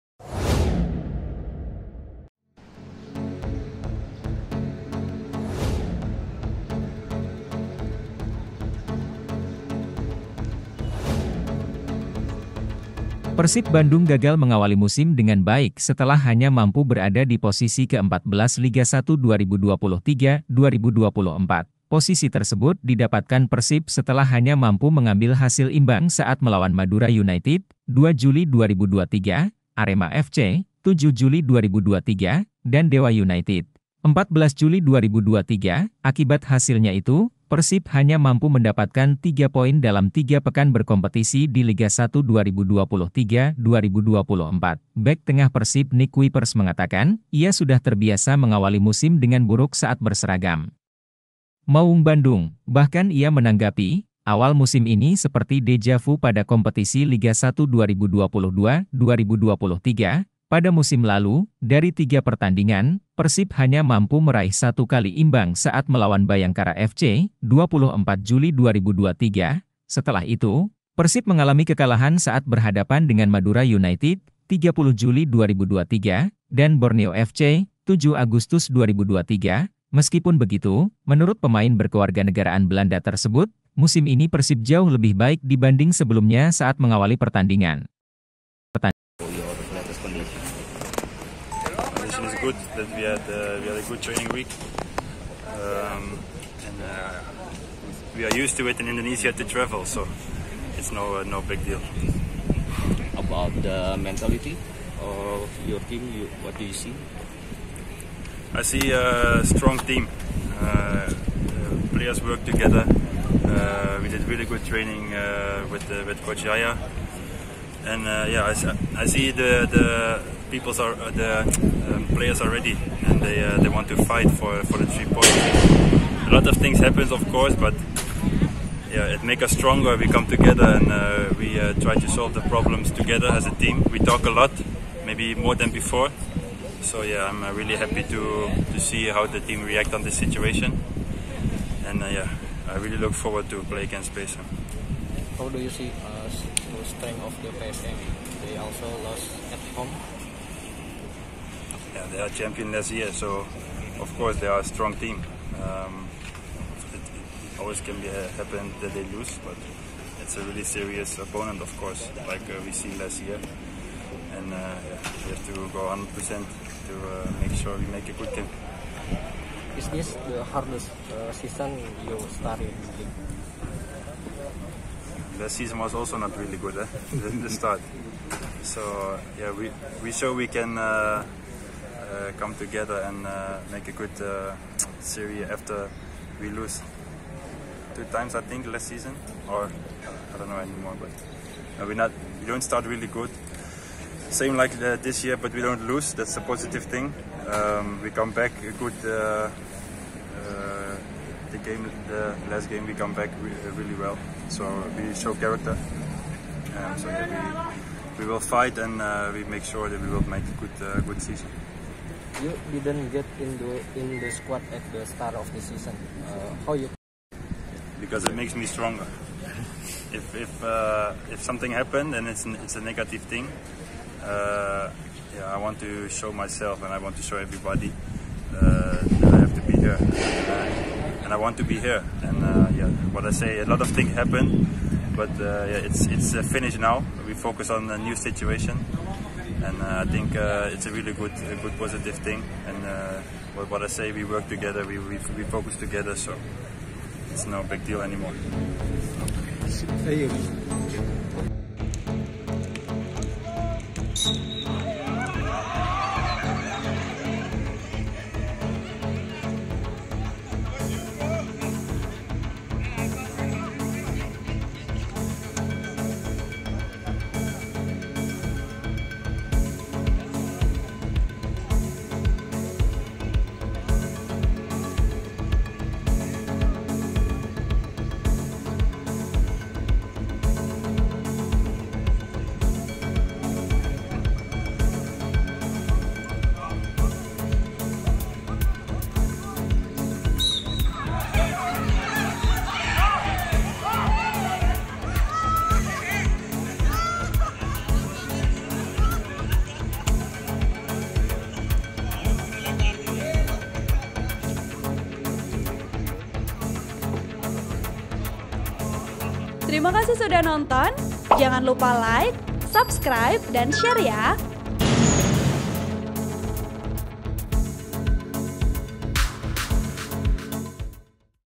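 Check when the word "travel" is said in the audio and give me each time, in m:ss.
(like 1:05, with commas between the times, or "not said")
1:39.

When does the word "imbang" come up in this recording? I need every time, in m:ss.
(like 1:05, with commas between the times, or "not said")
0:25, 1:05.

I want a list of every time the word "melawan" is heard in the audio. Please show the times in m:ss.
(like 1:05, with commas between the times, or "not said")
0:26, 1:05.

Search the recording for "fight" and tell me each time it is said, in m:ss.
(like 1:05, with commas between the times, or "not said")
2:04, 3:28.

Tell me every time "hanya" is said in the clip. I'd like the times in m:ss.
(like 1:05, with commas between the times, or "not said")
0:16, 0:24, 0:37, 1:03.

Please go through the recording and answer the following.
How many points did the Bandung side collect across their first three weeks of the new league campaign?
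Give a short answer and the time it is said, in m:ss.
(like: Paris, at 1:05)
3, at 0:39.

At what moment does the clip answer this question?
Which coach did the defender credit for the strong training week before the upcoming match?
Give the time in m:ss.
1:56.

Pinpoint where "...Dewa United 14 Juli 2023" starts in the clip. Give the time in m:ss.
0:32.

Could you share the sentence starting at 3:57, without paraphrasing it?
We focus on a new situation, and uh, I think uh, it's a really good a good positive thing.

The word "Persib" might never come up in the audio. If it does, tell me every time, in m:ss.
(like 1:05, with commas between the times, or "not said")
0:13, 0:23, 0:37, 0:45, 1:03, 1:10, 1:24.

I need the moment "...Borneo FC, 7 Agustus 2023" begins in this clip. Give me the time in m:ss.
1:16.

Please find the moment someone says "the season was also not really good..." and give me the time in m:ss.
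2:55.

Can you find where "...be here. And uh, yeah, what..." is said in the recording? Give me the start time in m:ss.
3:51.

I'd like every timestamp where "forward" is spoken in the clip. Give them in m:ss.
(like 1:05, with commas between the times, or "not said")
2:23.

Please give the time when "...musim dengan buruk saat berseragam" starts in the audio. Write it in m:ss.
0:48.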